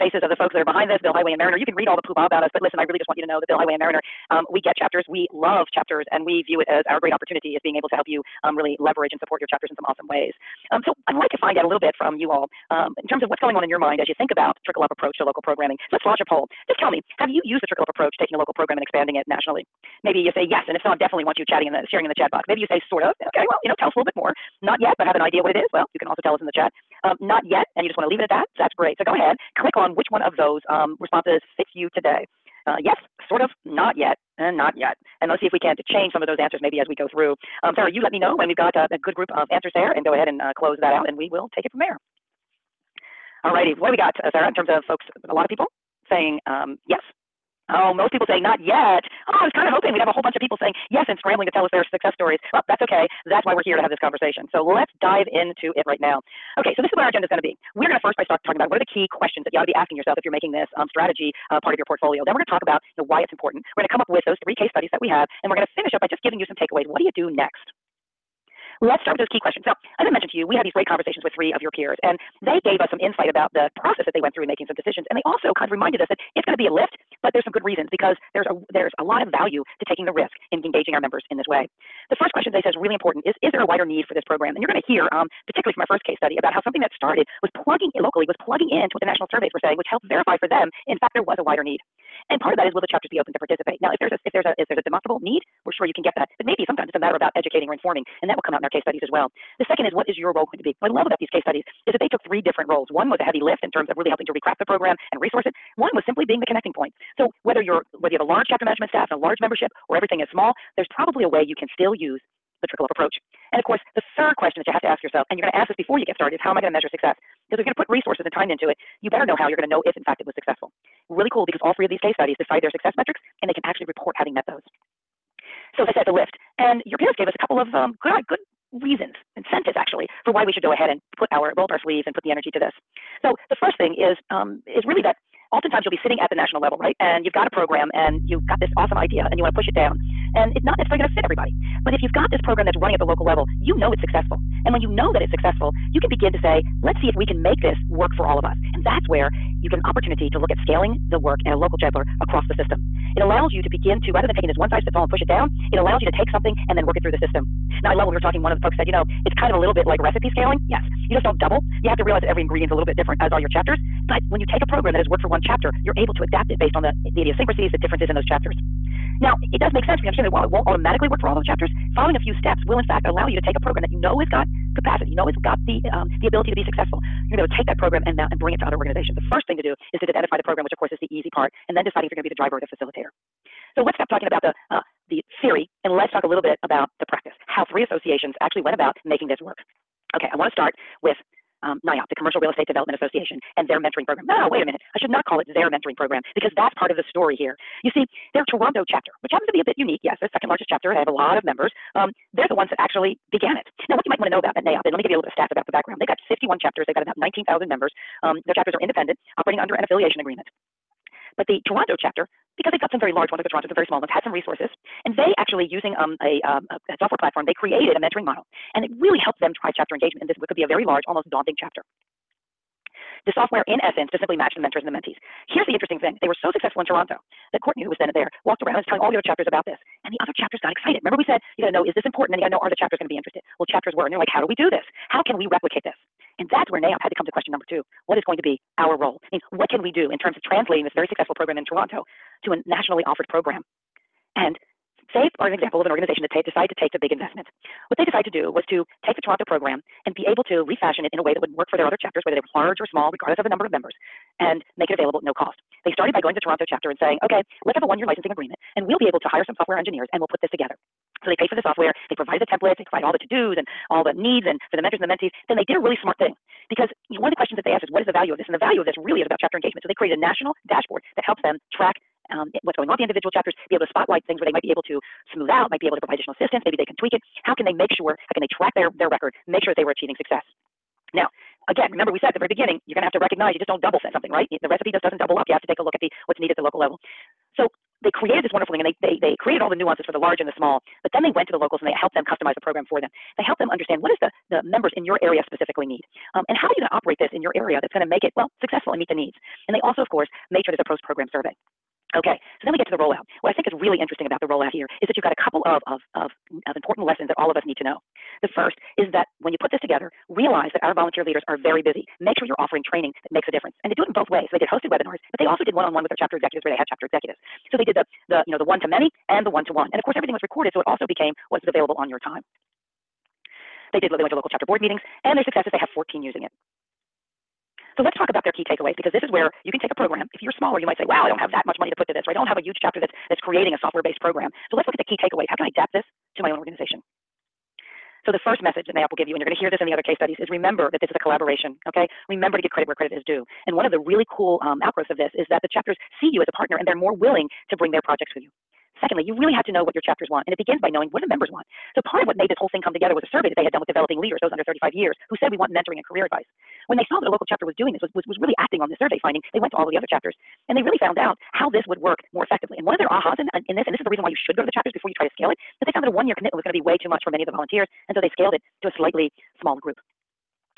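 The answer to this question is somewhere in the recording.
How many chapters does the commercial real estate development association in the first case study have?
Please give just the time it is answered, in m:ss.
3:26.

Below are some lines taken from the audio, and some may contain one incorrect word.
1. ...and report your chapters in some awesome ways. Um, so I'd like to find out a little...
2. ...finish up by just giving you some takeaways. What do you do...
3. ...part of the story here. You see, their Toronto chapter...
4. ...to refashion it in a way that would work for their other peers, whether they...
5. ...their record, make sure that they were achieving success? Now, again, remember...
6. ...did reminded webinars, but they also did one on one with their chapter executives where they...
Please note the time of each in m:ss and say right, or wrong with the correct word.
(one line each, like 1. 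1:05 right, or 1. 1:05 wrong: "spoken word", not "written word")
1. 0:09 wrong: "support", not "report"
2. 1:05 right
3. 3:16 right
4. 4:10 wrong: "chapters", not "peers"
5. 4:38 right
6. 5:14 wrong: "hosted", not "reminded".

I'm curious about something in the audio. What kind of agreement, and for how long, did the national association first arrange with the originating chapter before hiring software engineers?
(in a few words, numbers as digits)
One year licensing agreement.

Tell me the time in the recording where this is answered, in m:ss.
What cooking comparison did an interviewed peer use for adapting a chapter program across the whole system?
2:39.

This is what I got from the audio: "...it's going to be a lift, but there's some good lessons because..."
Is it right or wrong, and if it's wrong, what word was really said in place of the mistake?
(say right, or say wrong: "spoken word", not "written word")
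wrong: "reasons", not "lessons".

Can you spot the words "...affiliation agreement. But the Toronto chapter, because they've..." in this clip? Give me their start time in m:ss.
3:29.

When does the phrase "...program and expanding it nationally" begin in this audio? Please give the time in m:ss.
0:18.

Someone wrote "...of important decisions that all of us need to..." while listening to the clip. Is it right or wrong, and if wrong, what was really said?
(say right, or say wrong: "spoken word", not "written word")
wrong: "lessons", not "decisions".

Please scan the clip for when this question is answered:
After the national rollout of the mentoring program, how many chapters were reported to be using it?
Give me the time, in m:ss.
5:25.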